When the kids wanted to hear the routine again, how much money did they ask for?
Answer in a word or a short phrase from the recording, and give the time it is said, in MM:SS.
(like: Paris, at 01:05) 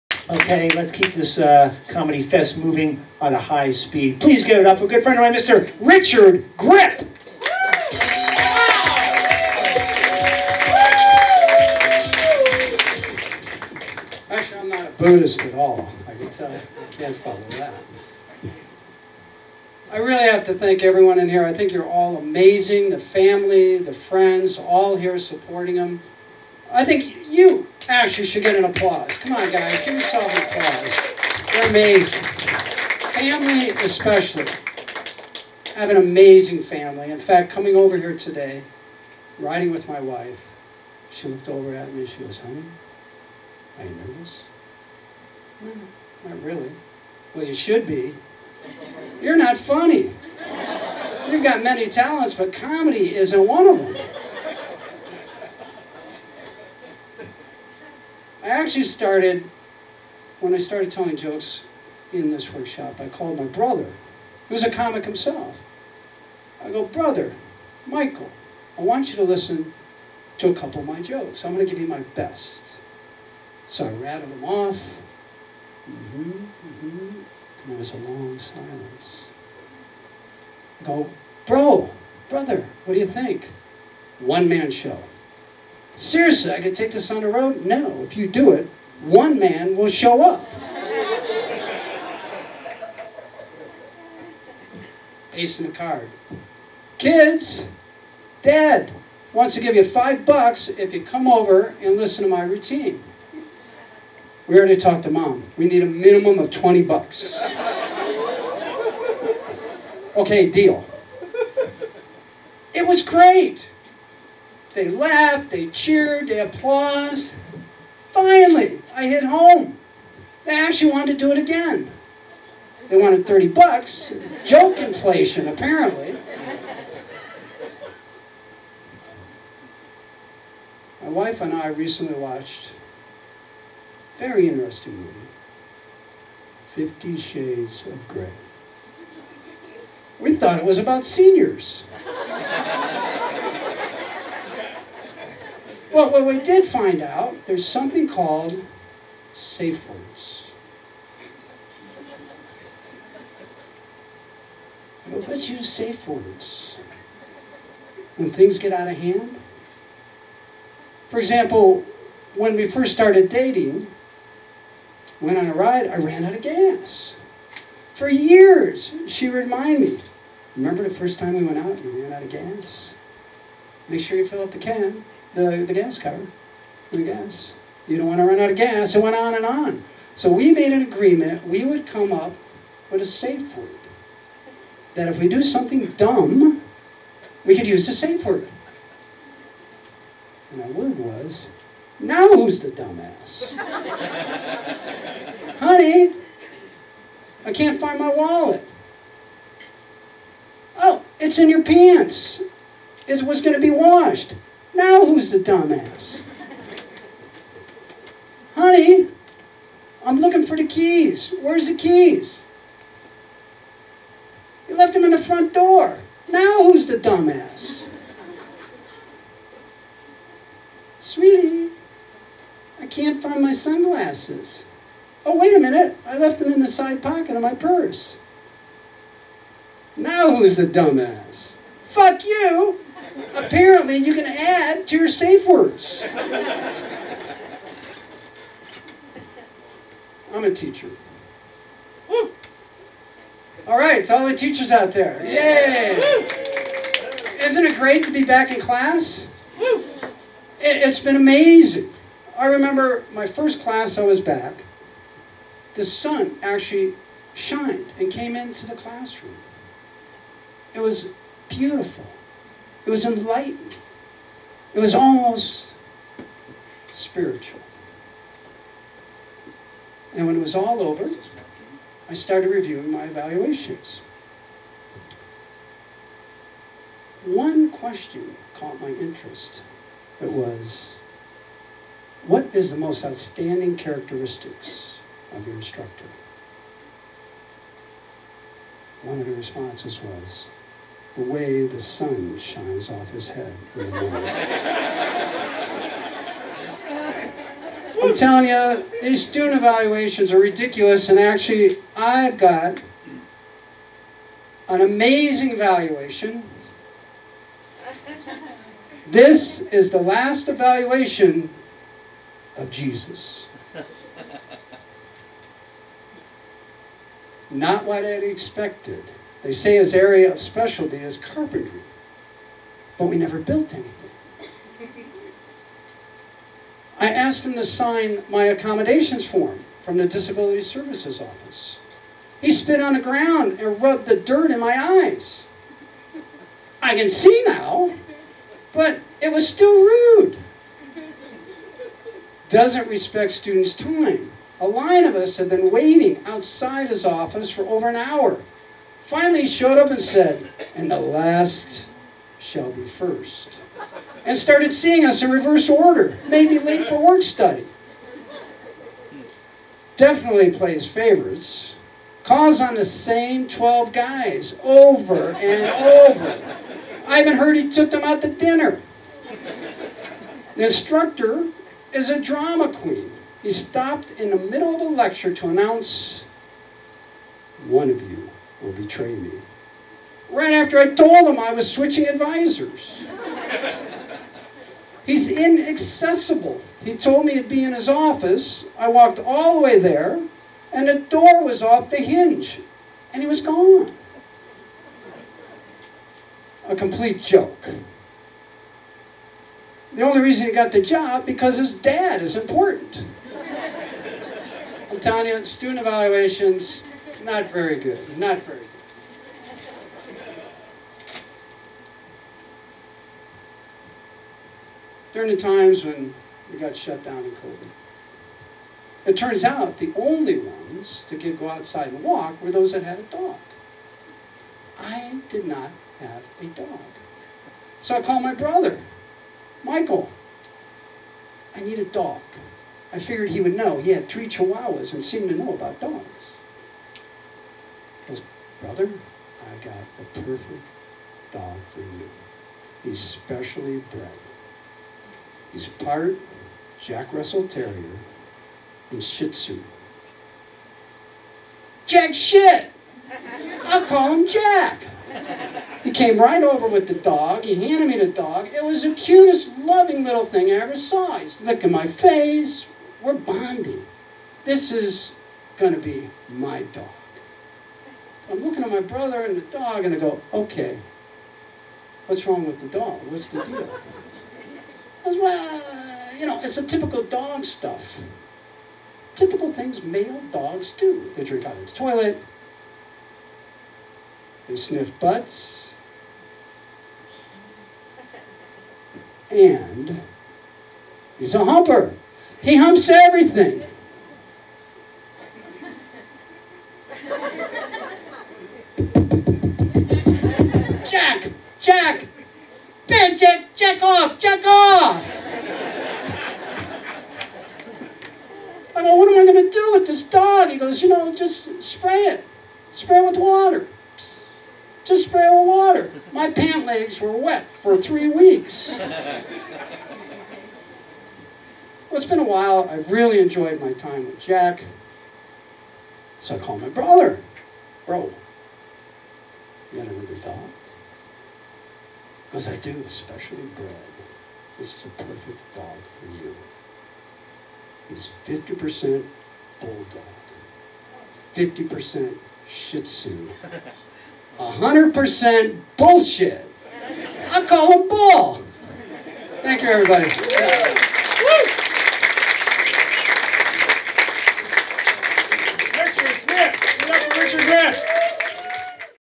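$30, at 02:03.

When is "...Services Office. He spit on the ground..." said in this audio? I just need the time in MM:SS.
05:30.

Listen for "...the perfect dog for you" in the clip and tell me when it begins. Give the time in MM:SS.
07:19.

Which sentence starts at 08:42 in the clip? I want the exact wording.
I have really enjoyed my time with Jack.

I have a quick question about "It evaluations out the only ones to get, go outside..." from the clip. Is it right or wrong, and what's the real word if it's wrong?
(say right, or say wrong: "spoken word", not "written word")
wrong: "turns", not "evaluations".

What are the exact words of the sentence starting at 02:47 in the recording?
For years, she reminded me, remember the first time we went out, and ran out of gas?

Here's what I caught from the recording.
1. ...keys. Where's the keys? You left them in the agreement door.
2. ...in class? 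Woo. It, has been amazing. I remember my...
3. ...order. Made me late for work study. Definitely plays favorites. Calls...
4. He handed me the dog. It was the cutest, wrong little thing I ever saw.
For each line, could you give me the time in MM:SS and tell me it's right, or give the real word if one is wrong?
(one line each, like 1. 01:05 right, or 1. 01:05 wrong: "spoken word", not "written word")
1. 03:30 wrong: "front", not "agreement"
2. 04:08 right
3. 05:55 right
4. 07:37 wrong: "loving", not "wrong".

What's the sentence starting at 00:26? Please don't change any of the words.
I think you, Actually, should get an applause.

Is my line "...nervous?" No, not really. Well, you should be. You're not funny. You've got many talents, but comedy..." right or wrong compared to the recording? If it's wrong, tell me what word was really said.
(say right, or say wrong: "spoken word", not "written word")
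right.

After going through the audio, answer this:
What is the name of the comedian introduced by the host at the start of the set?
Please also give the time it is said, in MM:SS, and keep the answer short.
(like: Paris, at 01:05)
Richard Grip, at 00:05.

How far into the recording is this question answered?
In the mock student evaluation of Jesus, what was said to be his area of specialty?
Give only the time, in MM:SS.
05:21.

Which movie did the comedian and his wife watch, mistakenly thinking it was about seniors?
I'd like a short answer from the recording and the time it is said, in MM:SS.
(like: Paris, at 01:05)
Fifty Shades of Grey, at 02:16.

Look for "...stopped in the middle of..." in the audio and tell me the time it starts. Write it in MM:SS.
06:13.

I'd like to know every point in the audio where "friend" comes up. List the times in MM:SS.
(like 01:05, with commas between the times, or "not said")
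00:05, 00:24.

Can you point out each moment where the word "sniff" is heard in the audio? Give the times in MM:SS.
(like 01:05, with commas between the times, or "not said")
08:04.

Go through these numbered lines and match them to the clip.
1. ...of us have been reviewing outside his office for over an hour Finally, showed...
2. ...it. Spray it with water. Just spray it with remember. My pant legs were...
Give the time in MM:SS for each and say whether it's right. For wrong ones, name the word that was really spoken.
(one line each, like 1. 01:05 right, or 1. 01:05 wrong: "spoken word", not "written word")
1. 05:45 wrong: "waiting", not "reviewing"
2. 08:32 wrong: "water", not "remember".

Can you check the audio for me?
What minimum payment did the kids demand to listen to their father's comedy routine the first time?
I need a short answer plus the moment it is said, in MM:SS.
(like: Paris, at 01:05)
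$20, at 01:46.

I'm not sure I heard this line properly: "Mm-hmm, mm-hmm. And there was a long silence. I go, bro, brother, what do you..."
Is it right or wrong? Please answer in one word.
right.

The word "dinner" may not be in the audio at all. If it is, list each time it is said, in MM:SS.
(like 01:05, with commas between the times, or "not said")
06:08.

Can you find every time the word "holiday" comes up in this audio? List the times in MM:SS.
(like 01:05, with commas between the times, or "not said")
not said.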